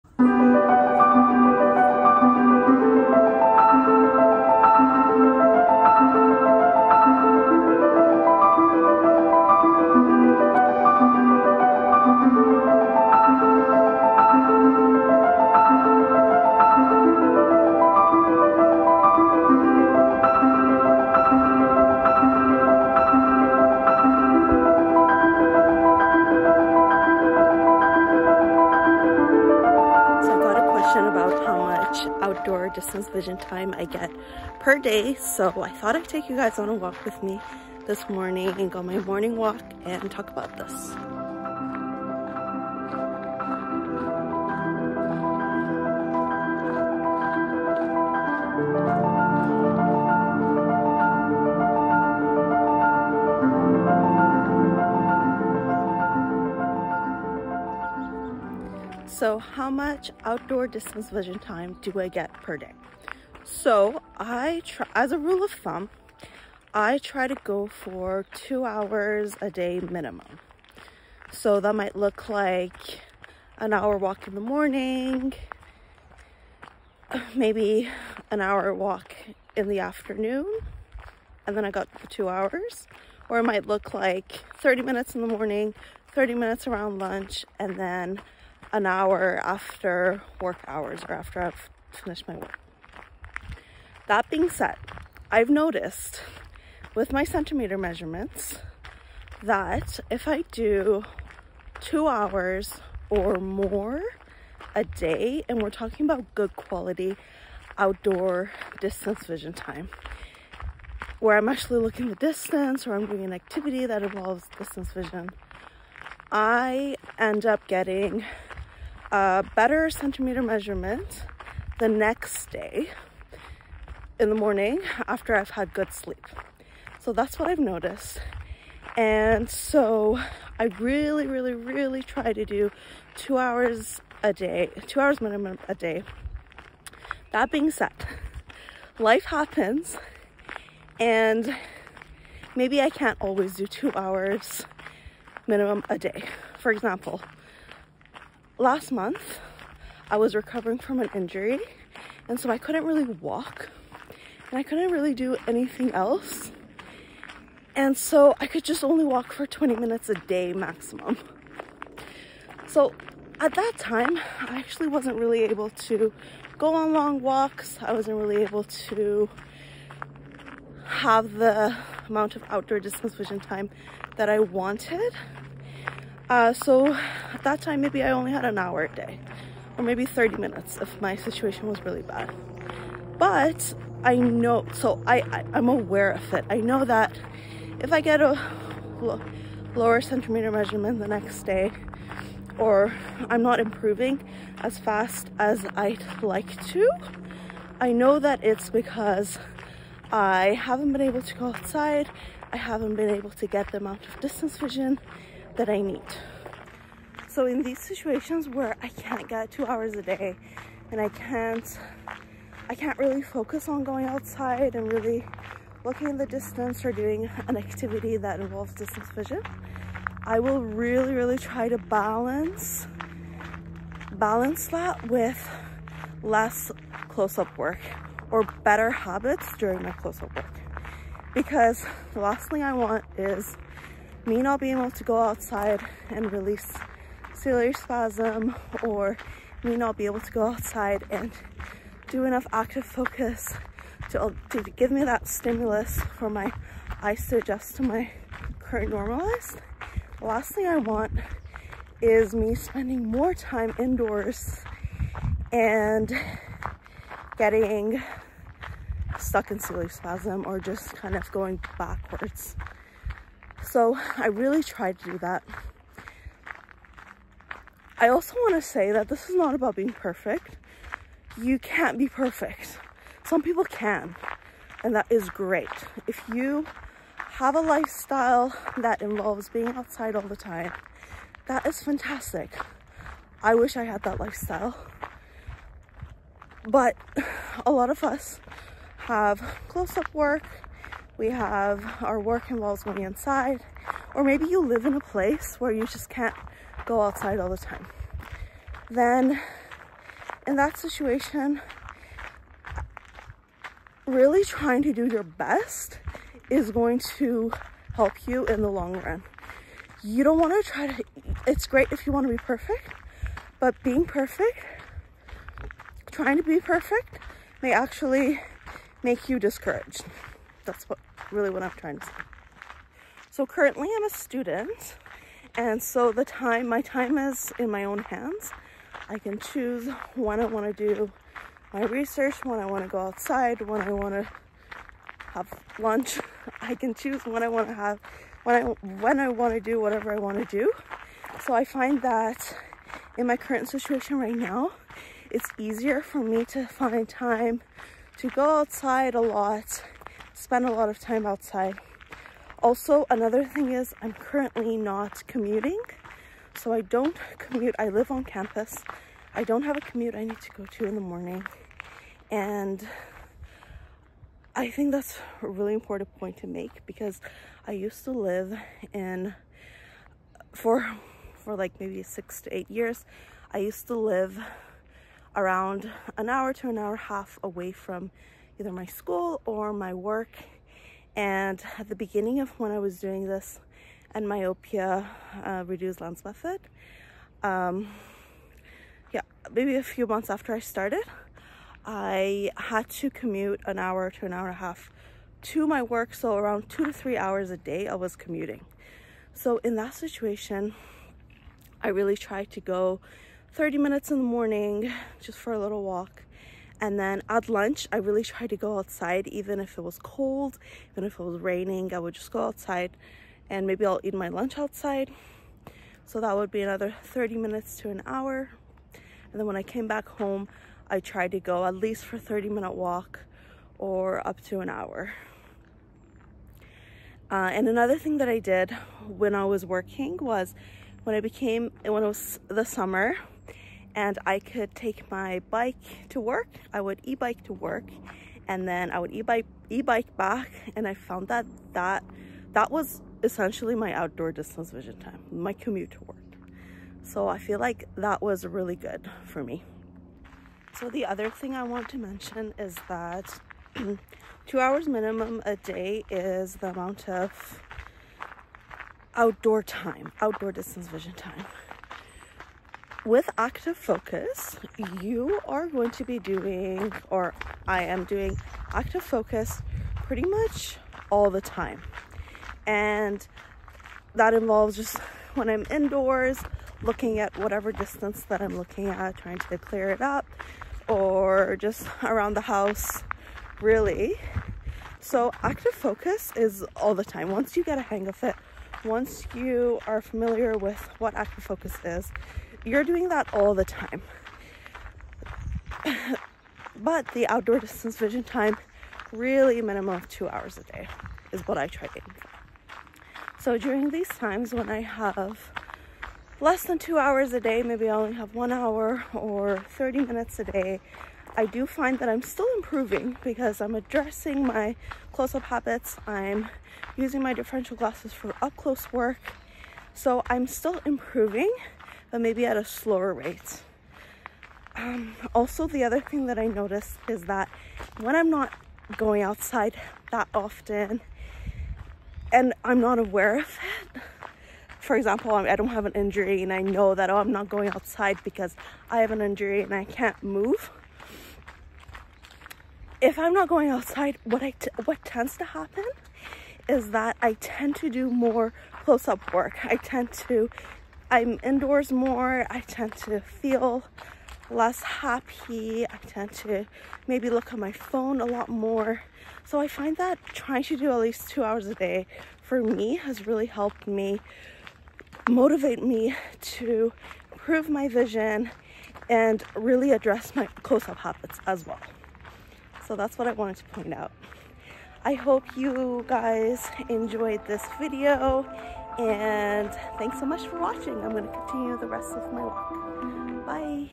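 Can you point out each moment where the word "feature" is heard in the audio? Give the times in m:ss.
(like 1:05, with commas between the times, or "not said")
not said.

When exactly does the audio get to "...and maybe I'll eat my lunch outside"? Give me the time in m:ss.
6:53.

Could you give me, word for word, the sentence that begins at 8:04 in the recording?
So active focus is all the time.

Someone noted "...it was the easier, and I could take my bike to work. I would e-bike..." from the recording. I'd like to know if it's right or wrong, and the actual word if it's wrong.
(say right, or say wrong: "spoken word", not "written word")
wrong: "summer", not "easier".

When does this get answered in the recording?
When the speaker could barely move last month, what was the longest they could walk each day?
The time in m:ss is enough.
2:39.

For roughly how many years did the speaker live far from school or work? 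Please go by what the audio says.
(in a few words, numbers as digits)
6 to 8 years.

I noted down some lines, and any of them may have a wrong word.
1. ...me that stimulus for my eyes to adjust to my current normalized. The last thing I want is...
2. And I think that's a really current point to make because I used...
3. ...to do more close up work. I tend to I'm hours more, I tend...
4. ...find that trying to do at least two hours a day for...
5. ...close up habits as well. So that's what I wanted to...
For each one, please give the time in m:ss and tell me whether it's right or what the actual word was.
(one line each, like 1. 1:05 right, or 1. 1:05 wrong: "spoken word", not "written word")
1. 4:04 right
2. 6:02 wrong: "important", not "current"
3. 9:07 wrong: "indoors", not "hours"
4. 9:19 right
5. 9:30 right.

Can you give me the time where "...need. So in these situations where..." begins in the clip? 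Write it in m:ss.
3:25.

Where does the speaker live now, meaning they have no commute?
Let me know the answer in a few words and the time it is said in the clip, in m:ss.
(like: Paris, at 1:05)
On campus, at 5:58.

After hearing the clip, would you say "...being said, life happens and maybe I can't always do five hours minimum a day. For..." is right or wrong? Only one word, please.
wrong.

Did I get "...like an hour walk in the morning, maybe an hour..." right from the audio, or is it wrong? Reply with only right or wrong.
right.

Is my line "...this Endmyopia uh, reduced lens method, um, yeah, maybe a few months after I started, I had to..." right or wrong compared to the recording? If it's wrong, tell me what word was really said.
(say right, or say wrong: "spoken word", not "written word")
right.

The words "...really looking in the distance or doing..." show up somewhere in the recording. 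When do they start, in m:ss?
3:34.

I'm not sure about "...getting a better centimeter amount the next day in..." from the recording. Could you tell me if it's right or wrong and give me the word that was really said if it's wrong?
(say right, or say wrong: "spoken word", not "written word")
wrong: "measurement", not "amount".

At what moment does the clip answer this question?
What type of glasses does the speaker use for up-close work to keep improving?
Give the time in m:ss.
8:37.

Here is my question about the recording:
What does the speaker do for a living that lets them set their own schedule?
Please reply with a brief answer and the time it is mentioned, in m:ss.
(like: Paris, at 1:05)
Student, at 5:24.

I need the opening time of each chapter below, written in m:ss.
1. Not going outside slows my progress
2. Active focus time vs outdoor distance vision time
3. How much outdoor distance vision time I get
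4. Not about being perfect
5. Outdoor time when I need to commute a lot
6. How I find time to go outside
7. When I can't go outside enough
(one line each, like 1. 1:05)
1. 8:23
2. 7:30
3. 0:59
4. 4:27
5. 5:52
6. 5:23
7. 3:27.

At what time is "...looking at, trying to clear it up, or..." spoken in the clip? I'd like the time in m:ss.
7:58.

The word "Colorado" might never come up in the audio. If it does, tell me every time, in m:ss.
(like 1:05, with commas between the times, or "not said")
not said.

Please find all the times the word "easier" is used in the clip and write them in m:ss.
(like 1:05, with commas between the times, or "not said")
5:45.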